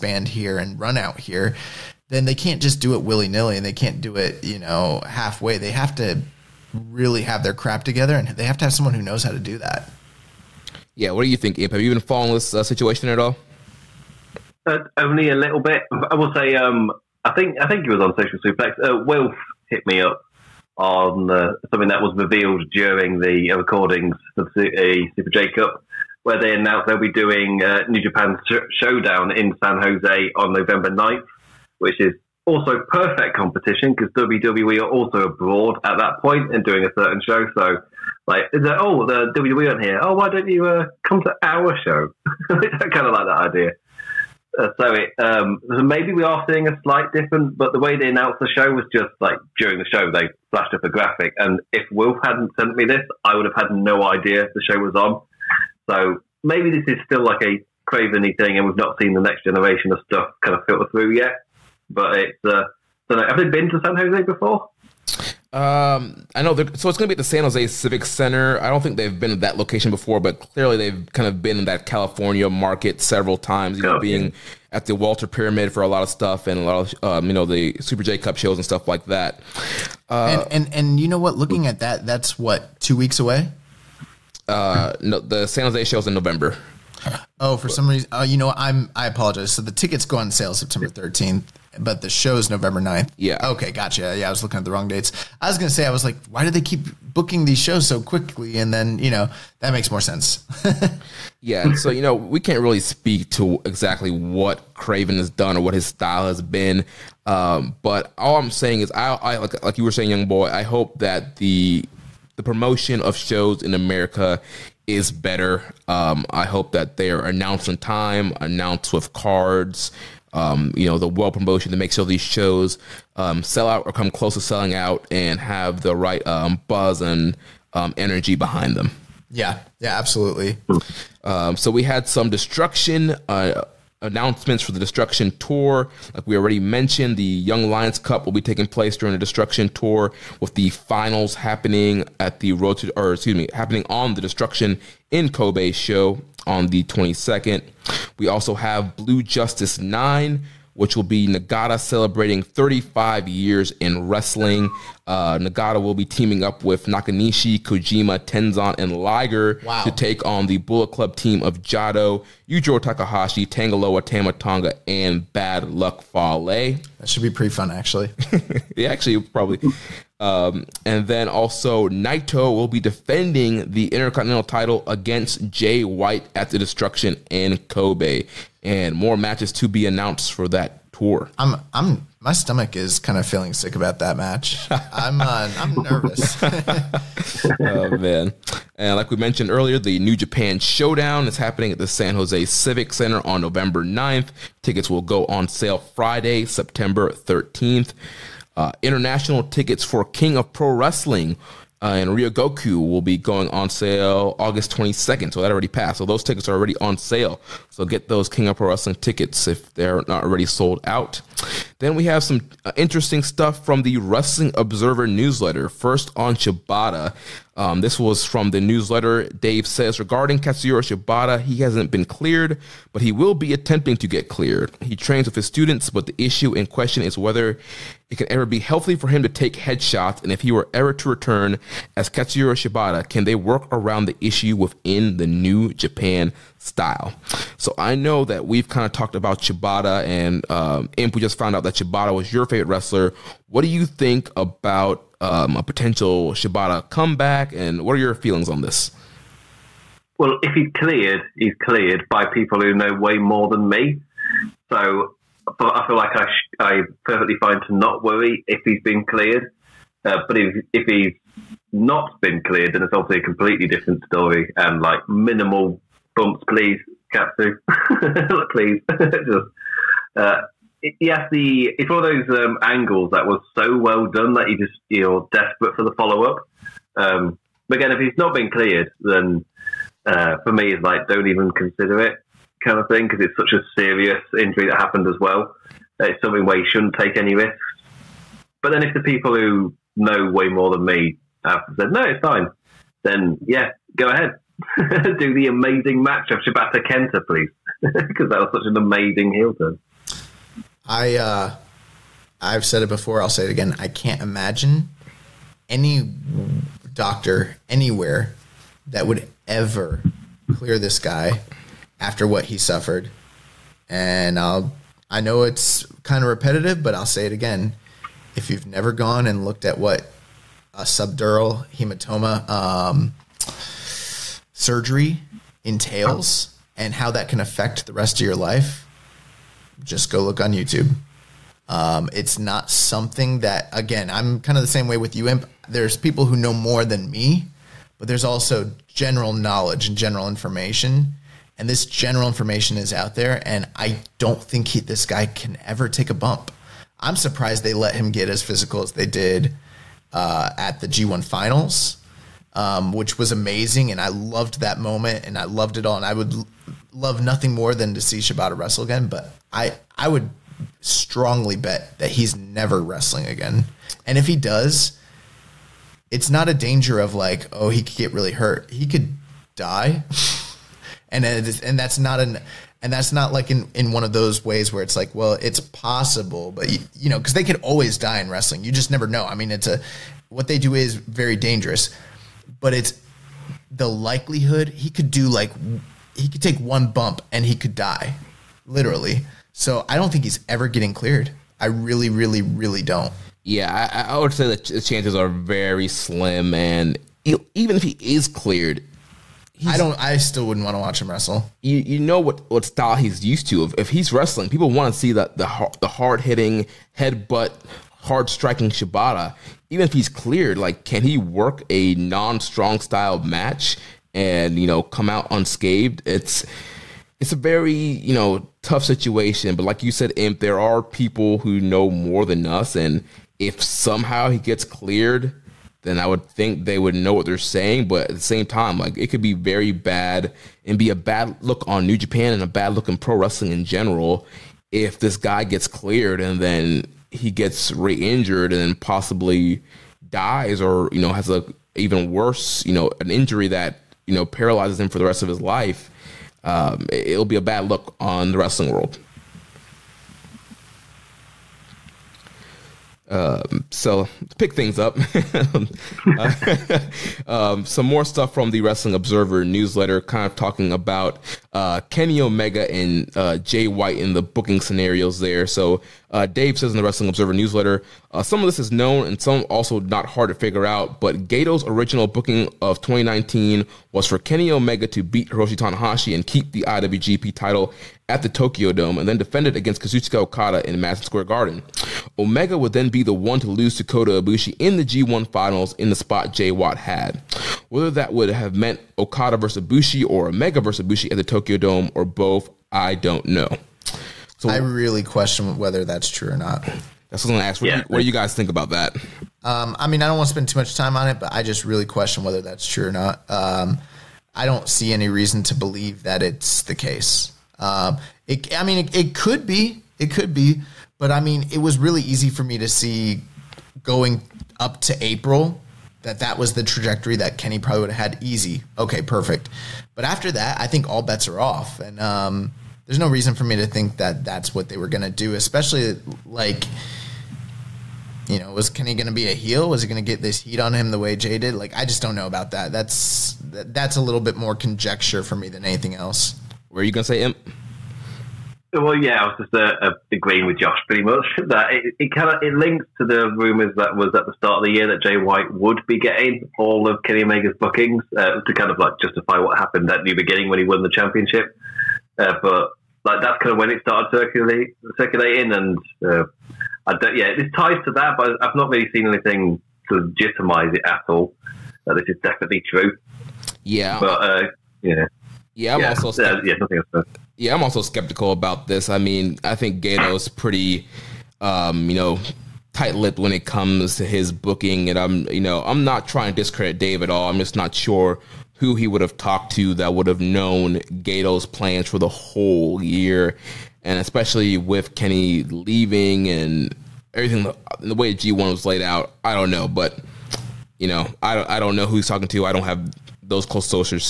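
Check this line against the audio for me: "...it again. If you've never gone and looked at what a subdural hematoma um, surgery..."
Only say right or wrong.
right.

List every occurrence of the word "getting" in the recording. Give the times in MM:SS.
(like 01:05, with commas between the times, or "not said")
06:30, 09:05.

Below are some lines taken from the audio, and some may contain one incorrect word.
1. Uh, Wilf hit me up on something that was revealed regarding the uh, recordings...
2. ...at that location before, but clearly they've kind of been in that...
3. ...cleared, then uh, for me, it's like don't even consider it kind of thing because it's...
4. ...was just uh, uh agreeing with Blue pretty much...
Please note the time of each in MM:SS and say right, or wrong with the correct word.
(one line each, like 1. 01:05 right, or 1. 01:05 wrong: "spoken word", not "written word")
1. 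00:18 wrong: "during", not "regarding"
2. 01:09 right
3. 04:38 right
4. 08:59 wrong: "Josh", not "Blue".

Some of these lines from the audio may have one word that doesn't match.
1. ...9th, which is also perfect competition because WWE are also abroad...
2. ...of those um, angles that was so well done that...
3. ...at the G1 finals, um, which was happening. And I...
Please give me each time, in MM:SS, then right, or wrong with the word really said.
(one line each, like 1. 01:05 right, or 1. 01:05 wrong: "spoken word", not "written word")
1. 00:30 right
2. 04:32 right
3. 05:50 wrong: "amazing", not "happening".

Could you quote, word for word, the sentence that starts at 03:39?
Dave says regarding Katsuyori Shibata, he hasn't been cleared, but he will be attempting to get cleared.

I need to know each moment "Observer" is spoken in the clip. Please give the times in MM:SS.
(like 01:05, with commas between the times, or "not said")
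03:34, 07:38, 07:47.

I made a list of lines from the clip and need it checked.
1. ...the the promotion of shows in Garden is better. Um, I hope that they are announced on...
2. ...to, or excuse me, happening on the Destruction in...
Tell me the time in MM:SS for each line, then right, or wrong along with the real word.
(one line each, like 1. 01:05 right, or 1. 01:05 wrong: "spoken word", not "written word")
1. 01:51 wrong: "America", not "Garden"
2. 02:22 right.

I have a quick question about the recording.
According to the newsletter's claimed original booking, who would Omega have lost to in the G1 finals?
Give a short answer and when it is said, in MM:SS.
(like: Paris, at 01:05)
Kota Ibushi, at 08:03.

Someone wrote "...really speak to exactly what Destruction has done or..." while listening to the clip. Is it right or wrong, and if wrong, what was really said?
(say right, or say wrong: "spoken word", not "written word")
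wrong: "Craven", not "Destruction".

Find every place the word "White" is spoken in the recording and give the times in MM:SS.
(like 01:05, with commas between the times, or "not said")
02:55, 07:43, 08:06, 09:05.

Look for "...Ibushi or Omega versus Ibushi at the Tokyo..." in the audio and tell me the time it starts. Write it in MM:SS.
08:09.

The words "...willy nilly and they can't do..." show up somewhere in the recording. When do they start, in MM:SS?
00:03.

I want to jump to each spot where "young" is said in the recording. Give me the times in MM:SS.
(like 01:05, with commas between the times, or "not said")
01:50, 02:17.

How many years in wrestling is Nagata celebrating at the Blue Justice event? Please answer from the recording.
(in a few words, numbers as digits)
35.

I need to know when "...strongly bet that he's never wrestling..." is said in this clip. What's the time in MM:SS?
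06:00.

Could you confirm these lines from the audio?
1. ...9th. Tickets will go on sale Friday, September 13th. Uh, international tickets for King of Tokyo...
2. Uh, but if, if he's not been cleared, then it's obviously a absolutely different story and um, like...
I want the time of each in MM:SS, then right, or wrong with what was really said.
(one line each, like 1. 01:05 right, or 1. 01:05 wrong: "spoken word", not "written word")
1. 03:13 wrong: "Pro", not "Tokyo"
2. 04:20 wrong: "completely", not "absolutely".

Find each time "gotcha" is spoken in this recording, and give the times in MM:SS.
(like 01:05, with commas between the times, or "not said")
01:33.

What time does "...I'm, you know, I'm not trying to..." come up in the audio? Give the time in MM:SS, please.
09:34.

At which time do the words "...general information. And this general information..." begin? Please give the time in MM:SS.
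05:39.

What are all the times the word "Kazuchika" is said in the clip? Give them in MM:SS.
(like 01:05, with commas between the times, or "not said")
07:59.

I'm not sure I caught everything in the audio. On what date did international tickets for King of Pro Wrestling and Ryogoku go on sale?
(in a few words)
August 22nd.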